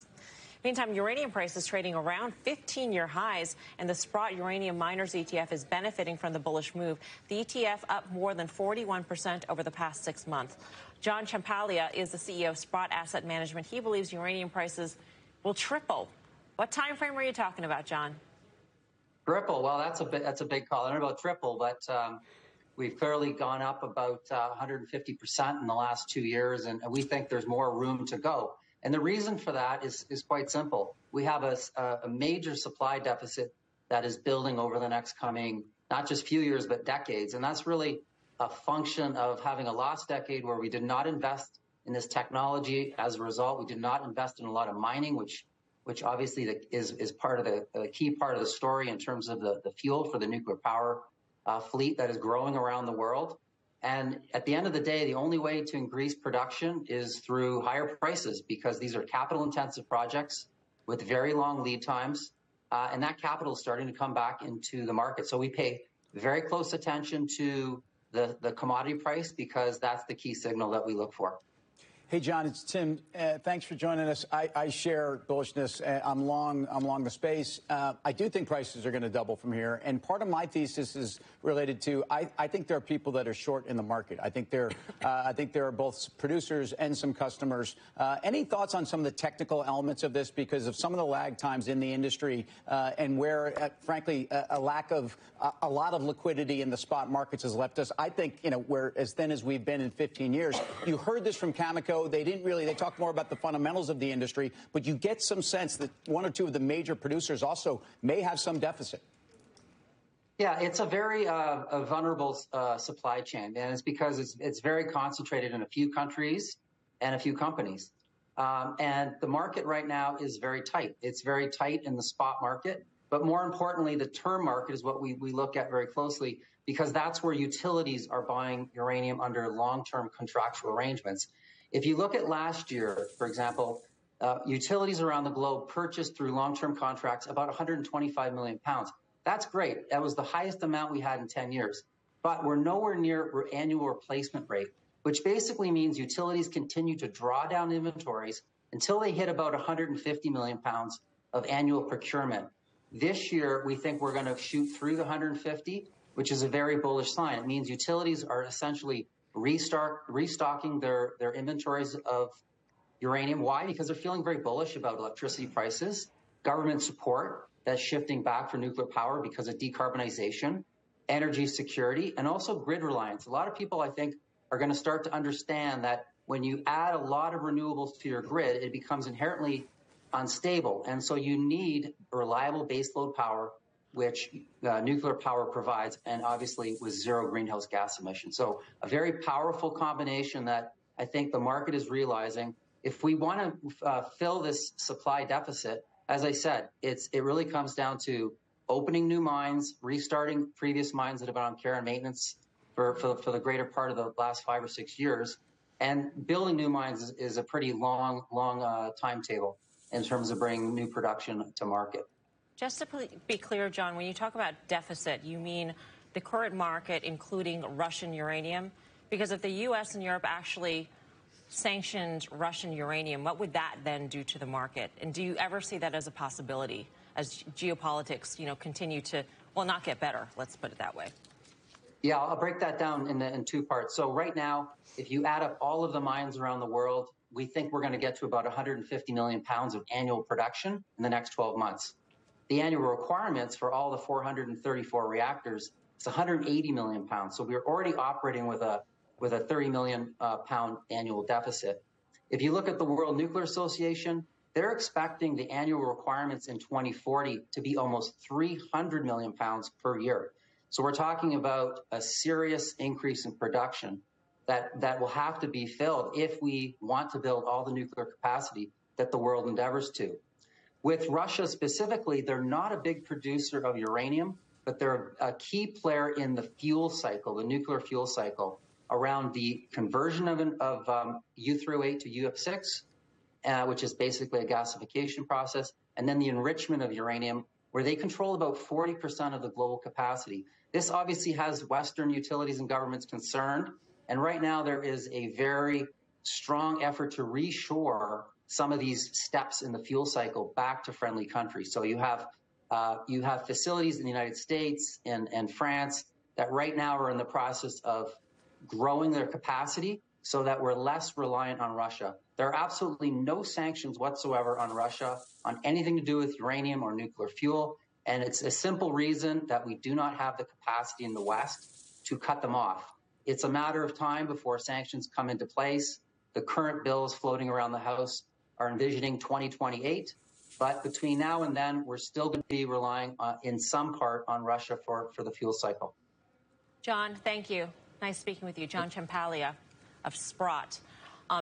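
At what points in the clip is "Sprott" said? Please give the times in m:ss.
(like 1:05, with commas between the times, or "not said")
0:03, 0:12, 5:40.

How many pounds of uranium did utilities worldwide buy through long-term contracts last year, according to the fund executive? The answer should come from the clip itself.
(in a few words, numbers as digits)
125 million pounds.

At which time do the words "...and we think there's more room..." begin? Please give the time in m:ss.
0:26.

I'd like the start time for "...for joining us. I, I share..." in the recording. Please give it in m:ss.
1:13.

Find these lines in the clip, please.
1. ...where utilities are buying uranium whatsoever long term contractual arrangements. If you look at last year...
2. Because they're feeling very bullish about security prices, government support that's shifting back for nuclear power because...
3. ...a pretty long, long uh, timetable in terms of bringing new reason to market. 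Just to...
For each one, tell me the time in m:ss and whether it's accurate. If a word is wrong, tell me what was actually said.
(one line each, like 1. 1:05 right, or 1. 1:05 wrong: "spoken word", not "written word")
1. 2:07 wrong: "under", not "whatsoever"
2. 2:43 wrong: "electricity", not "security"
3. 3:27 wrong: "production", not "reason".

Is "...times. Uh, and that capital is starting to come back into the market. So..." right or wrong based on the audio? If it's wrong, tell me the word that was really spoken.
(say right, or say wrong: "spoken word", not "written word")
right.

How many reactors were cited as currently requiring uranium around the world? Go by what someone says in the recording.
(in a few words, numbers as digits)
434.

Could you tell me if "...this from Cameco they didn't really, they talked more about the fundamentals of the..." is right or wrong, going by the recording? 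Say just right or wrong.
right.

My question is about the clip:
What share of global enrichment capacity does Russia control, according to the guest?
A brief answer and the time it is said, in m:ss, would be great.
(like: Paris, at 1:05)
40%, at 4:48.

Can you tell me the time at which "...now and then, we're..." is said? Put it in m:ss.
5:31.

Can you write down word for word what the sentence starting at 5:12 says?
There are absolutely no sanctions whatsoever on Russia on anything to do with uranium or nuclear fuel.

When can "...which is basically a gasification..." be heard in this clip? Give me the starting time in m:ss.
4:43.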